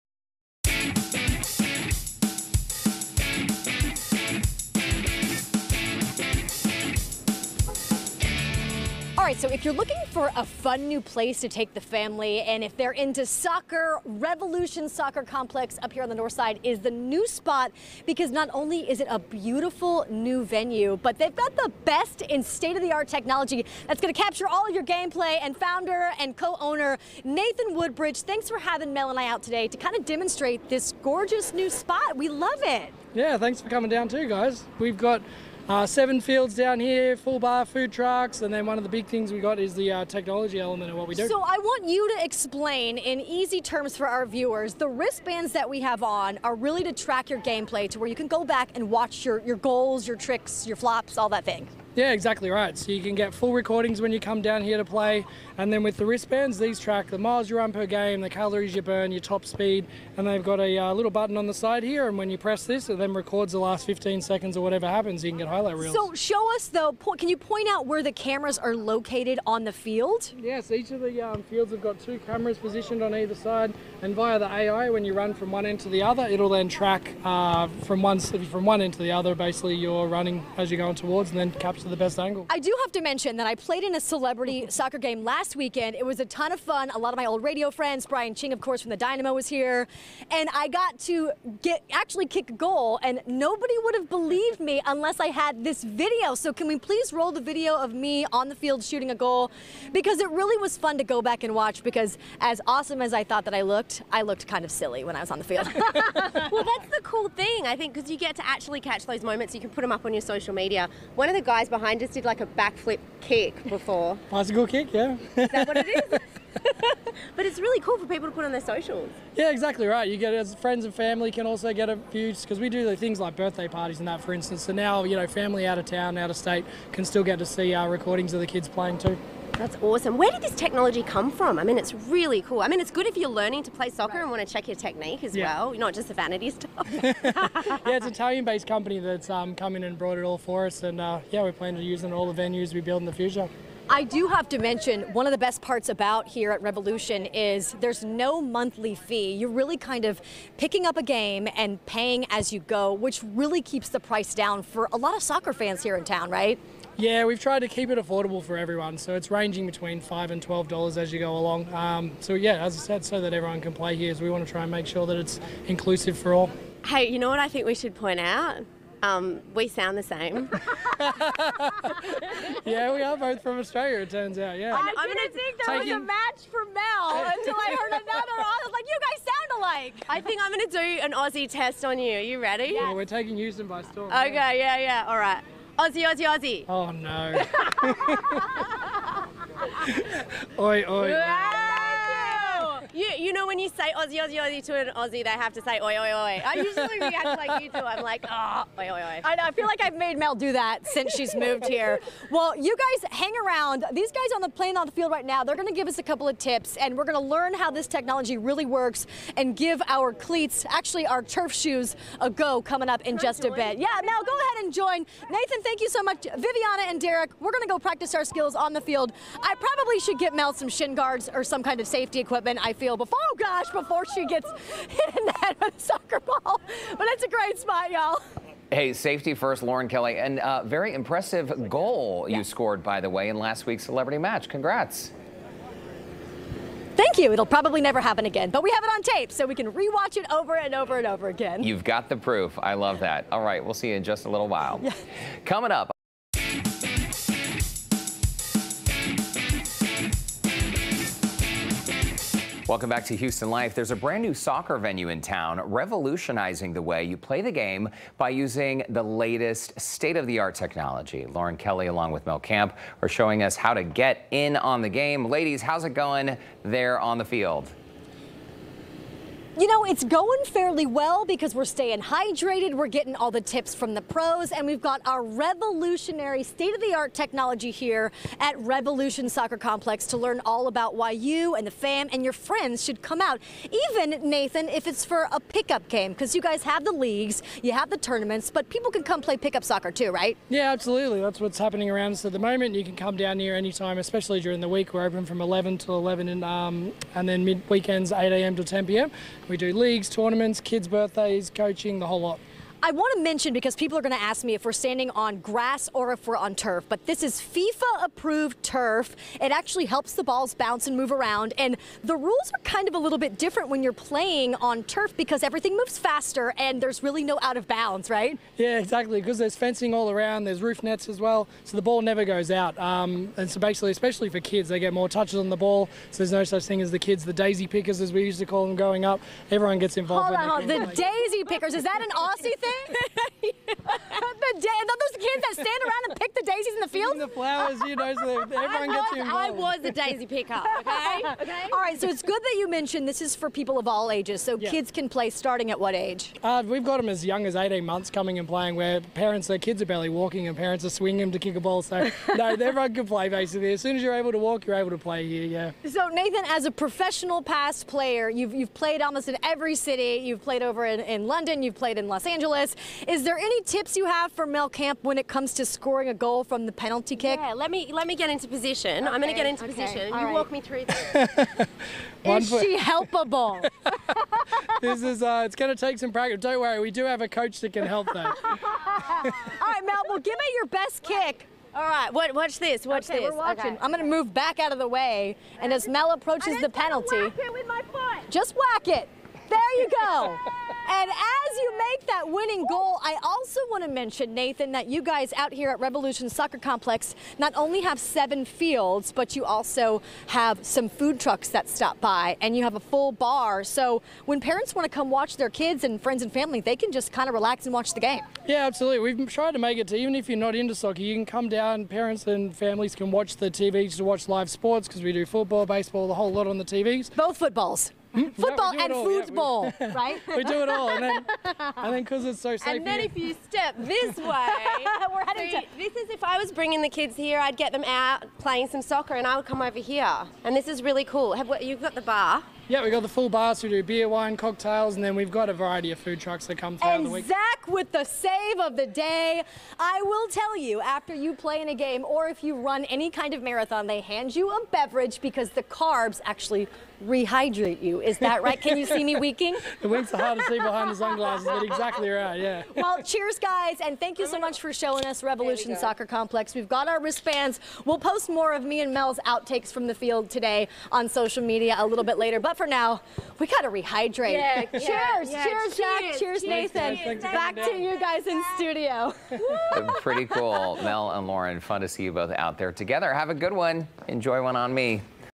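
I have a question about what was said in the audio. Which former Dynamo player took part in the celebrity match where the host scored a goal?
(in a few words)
Brian Ching.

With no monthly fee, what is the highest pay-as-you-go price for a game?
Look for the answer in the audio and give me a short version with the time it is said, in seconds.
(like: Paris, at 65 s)
$12, at 160 s.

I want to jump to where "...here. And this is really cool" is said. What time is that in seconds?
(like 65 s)
429 s.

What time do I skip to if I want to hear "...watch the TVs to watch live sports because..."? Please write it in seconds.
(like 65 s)
413 s.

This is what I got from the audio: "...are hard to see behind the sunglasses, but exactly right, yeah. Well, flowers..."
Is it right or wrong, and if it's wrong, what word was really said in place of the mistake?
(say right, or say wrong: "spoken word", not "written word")
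wrong: "cheers", not "flowers".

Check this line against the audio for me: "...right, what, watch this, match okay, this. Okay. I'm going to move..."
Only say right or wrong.
wrong.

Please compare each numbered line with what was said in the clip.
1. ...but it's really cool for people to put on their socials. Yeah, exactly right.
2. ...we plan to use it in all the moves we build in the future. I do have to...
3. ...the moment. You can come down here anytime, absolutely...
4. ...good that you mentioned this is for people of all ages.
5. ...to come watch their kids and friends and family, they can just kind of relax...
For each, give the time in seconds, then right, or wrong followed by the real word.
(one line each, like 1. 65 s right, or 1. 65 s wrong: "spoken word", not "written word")
1. 117 s right
2. 141 s wrong: "venues", not "moves"
3. 292 s wrong: "especially", not "absolutely"
4. 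342 s right
5. 404 s right.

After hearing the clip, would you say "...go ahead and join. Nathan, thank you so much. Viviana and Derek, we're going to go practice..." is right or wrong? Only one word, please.
right.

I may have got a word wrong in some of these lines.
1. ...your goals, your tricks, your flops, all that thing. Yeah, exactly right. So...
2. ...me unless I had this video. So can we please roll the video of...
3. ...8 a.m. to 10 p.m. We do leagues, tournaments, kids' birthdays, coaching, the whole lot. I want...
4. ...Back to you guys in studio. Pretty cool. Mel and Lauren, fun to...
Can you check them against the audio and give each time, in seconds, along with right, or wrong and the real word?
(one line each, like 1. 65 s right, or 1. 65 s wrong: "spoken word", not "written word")
1. 49 s right
2. 94 s right
3. 298 s right
4. 467 s right.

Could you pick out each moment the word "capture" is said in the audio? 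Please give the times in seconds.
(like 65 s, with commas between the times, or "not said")
24 s, 81 s.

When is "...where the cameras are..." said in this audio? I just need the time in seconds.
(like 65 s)
67 s.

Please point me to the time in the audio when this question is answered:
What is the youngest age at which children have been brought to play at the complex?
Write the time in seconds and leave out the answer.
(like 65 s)
347 s.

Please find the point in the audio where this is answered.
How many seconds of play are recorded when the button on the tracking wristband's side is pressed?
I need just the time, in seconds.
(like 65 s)
63 s.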